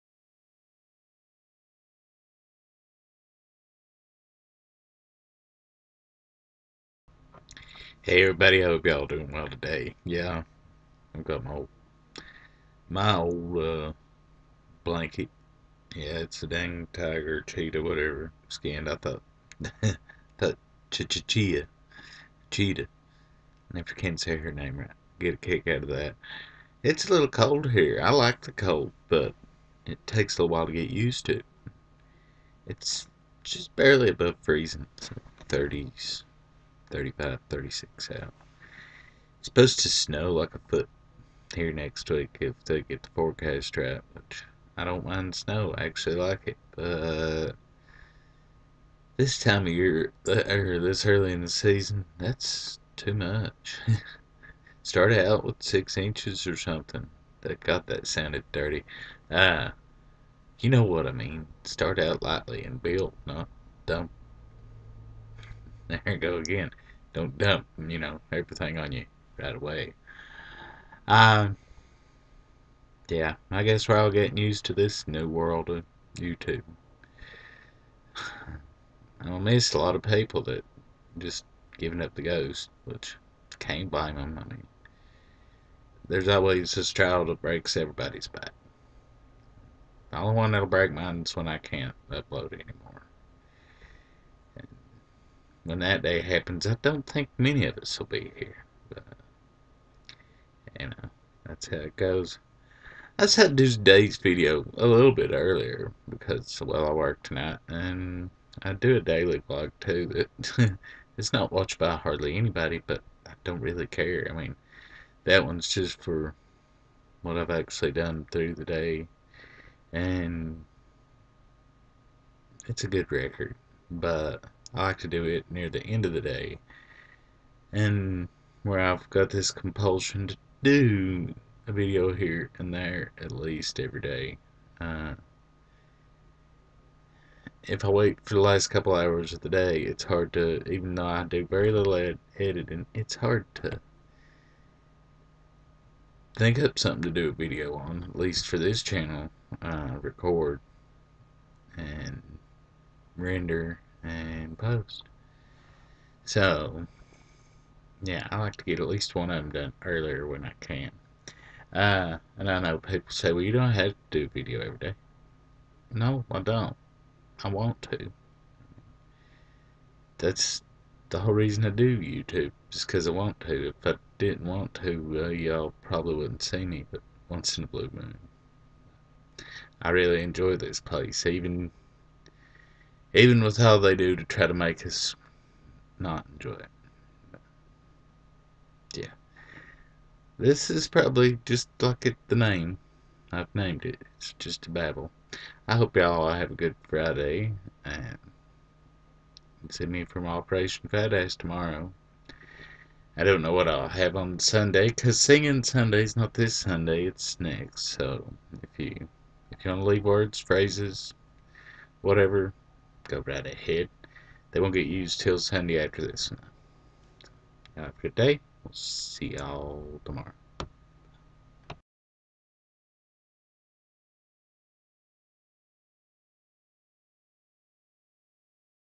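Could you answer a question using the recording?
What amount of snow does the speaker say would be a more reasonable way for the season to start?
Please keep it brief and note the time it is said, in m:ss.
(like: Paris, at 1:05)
6 inches, at 0:55.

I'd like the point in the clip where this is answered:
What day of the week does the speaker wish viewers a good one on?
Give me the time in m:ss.
3:16.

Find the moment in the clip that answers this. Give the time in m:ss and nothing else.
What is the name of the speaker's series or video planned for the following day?
3:20.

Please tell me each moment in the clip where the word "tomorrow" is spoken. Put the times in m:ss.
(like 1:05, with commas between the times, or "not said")
3:21, 3:40.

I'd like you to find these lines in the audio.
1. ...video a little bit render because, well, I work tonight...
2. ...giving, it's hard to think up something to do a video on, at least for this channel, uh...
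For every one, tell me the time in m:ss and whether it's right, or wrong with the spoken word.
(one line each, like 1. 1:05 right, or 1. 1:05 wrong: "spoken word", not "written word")
1. 1:44 wrong: "earlier", not "render"
2. 2:22 wrong: "editing", not "giving".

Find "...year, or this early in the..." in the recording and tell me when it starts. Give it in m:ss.
0:49.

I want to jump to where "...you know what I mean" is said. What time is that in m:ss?
1:00.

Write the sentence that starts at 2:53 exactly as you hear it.
If I didn't want to, uh, y'all probably wouldn't see me, but once in a blue moon.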